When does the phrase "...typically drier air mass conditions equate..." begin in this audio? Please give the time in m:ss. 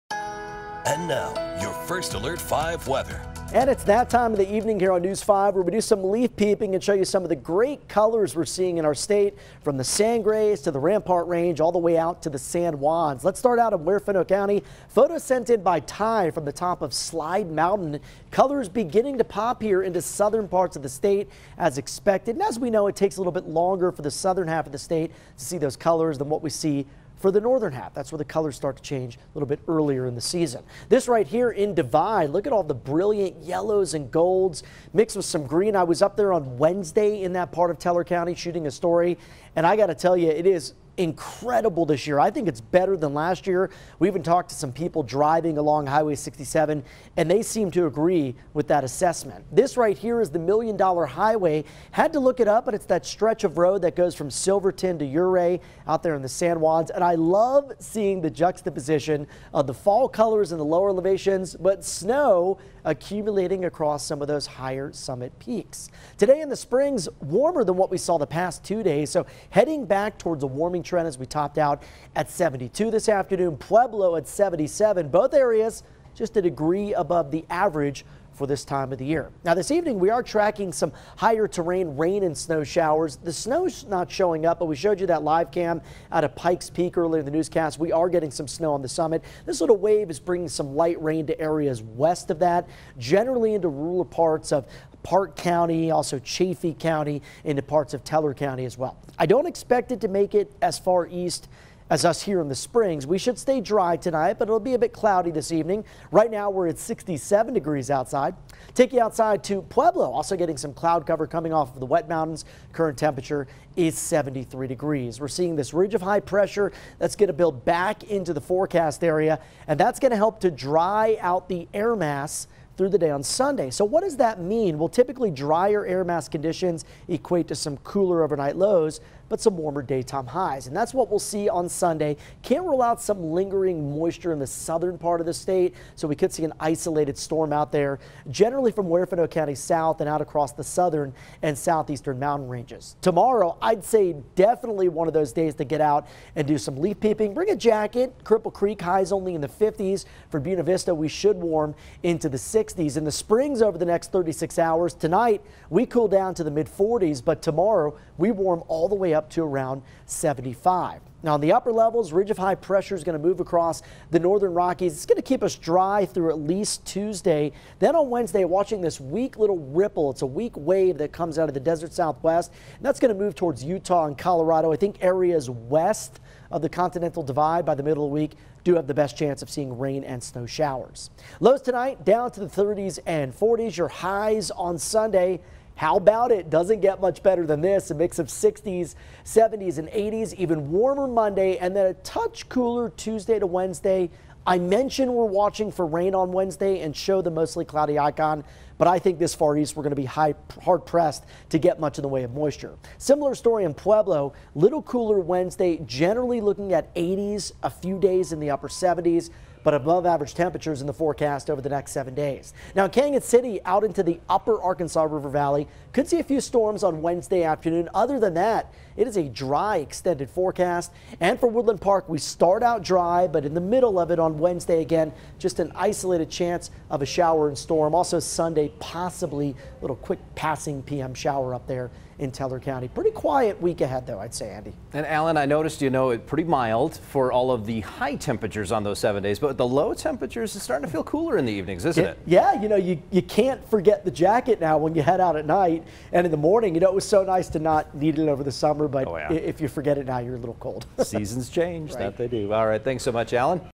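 2:04.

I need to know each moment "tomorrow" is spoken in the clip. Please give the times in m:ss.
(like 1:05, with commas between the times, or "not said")
2:23, 2:37.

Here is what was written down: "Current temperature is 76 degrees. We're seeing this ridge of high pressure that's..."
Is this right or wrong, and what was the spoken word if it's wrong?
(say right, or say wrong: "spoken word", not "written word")
wrong: "73", not "76".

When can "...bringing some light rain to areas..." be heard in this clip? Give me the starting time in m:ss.
1:30.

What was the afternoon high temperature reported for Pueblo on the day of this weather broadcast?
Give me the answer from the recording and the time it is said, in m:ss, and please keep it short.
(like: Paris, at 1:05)
77, at 1:14.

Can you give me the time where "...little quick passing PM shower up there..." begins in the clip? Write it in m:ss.
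3:49.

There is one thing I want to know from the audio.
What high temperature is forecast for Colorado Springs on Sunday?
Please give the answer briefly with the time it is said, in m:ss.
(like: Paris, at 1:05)
75, at 2:40.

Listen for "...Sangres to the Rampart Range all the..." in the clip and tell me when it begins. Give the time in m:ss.
0:09.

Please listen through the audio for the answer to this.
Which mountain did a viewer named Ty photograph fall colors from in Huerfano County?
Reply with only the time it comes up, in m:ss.
0:16.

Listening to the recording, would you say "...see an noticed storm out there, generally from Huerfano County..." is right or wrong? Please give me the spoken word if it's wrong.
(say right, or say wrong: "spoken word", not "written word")
wrong: "isolated", not "noticed".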